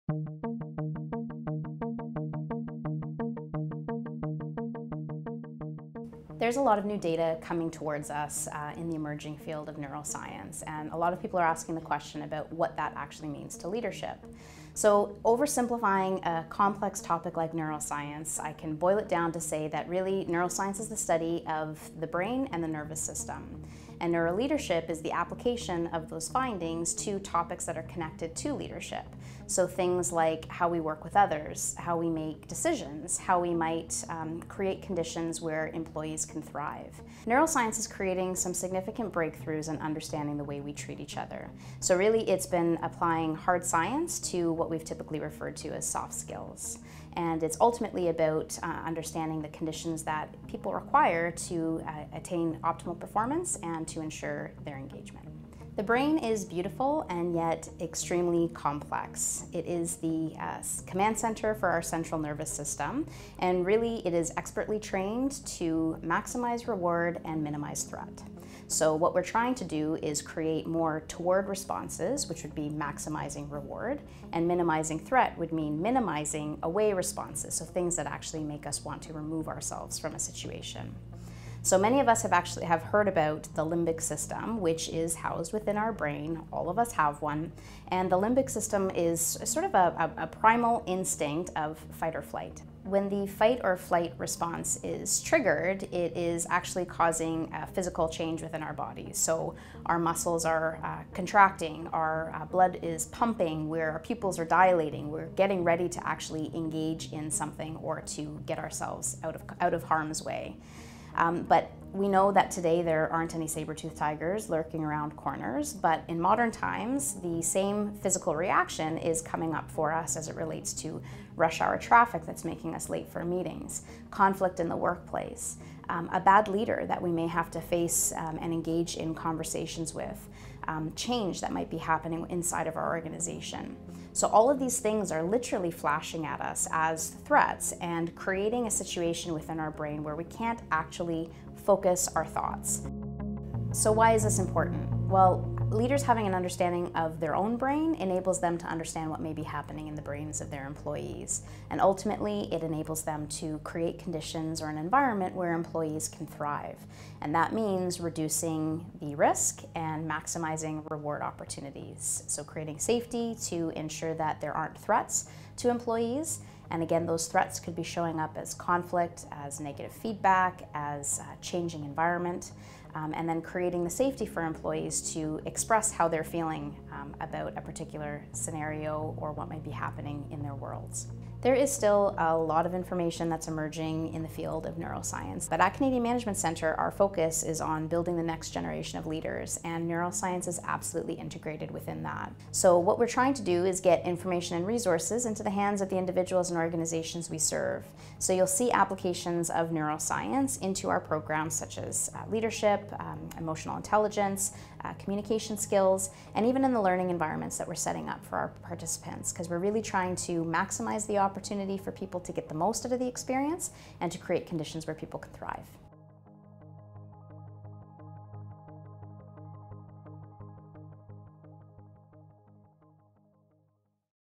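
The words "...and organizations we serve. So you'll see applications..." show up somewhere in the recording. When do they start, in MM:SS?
03:16.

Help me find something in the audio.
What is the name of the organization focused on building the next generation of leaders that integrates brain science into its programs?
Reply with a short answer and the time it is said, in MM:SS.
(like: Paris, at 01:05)
Canadian Management Centre, at 03:05.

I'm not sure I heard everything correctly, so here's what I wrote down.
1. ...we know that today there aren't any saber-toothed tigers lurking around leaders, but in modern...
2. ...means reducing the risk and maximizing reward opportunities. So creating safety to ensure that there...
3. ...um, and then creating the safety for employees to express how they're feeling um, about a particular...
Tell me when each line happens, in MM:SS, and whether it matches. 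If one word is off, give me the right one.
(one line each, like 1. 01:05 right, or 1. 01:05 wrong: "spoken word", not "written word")
1. 01:51 wrong: "corners", not "leaders"
2. 02:37 right
3. 02:52 right.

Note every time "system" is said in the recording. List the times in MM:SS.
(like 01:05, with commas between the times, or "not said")
00:23, 01:02, 01:24, 01:28.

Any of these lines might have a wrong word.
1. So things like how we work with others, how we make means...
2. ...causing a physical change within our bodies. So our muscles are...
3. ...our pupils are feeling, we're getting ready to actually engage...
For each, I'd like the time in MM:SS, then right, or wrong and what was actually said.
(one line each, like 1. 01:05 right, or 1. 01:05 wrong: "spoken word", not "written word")
1. 00:29 wrong: "decisions", not "means"
2. 01:36 right
3. 01:43 wrong: "dilating", not "feeling".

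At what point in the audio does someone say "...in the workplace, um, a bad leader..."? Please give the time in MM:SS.
02:04.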